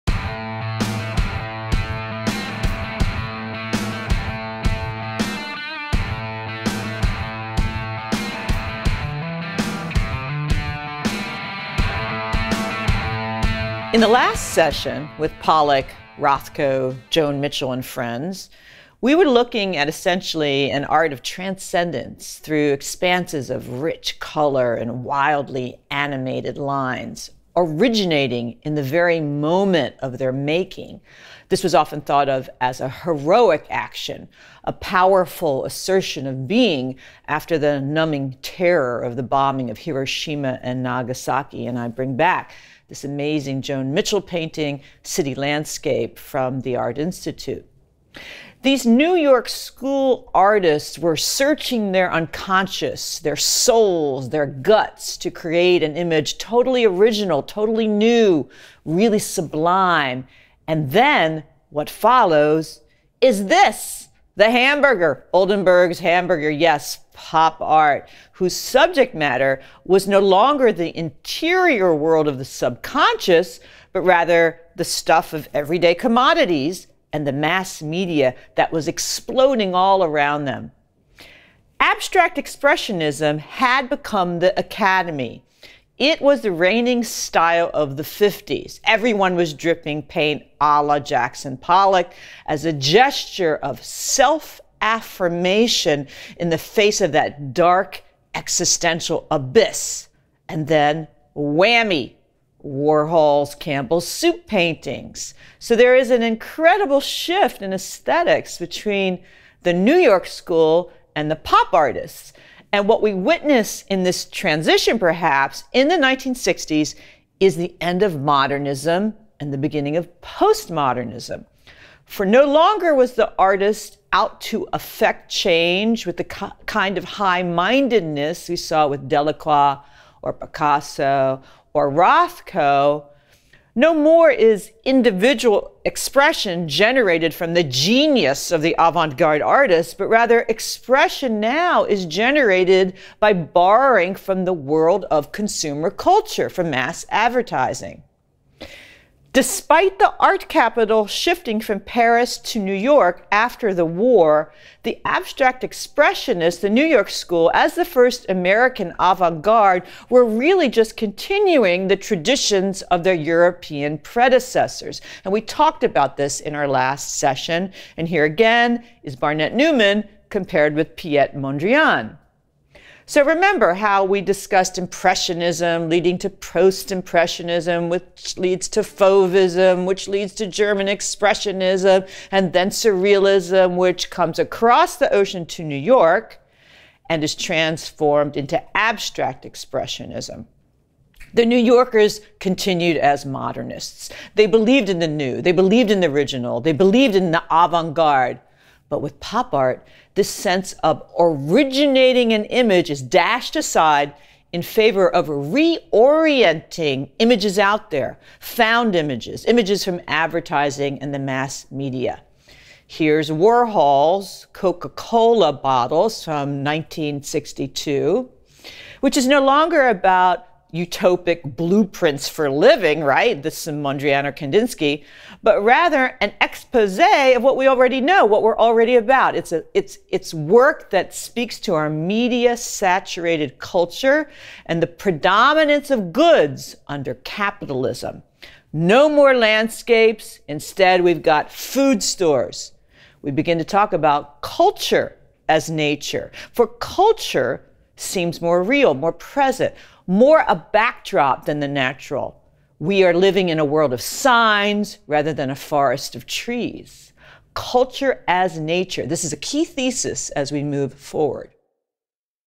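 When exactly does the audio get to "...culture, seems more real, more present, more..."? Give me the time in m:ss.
4:06.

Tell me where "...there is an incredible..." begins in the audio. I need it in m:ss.
1:45.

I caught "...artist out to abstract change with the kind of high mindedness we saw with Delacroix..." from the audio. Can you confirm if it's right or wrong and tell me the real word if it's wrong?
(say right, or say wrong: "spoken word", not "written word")
wrong: "affect", not "abstract".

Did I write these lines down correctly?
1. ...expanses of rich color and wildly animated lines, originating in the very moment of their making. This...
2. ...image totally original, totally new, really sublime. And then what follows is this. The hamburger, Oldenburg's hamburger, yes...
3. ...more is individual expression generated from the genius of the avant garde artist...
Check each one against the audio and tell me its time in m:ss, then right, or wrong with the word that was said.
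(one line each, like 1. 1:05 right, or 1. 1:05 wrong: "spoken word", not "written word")
1. 0:22 right
2. 0:55 right
3. 2:13 right.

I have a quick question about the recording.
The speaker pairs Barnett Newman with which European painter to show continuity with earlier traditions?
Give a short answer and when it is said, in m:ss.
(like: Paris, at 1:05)
Piet Mondrian, at 2:50.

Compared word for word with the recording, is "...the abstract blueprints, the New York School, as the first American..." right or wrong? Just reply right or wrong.
wrong.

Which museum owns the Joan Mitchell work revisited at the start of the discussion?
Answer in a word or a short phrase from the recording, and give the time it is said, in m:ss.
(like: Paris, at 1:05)
Art Institute, at 0:46.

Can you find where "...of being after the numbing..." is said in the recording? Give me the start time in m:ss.
0:36.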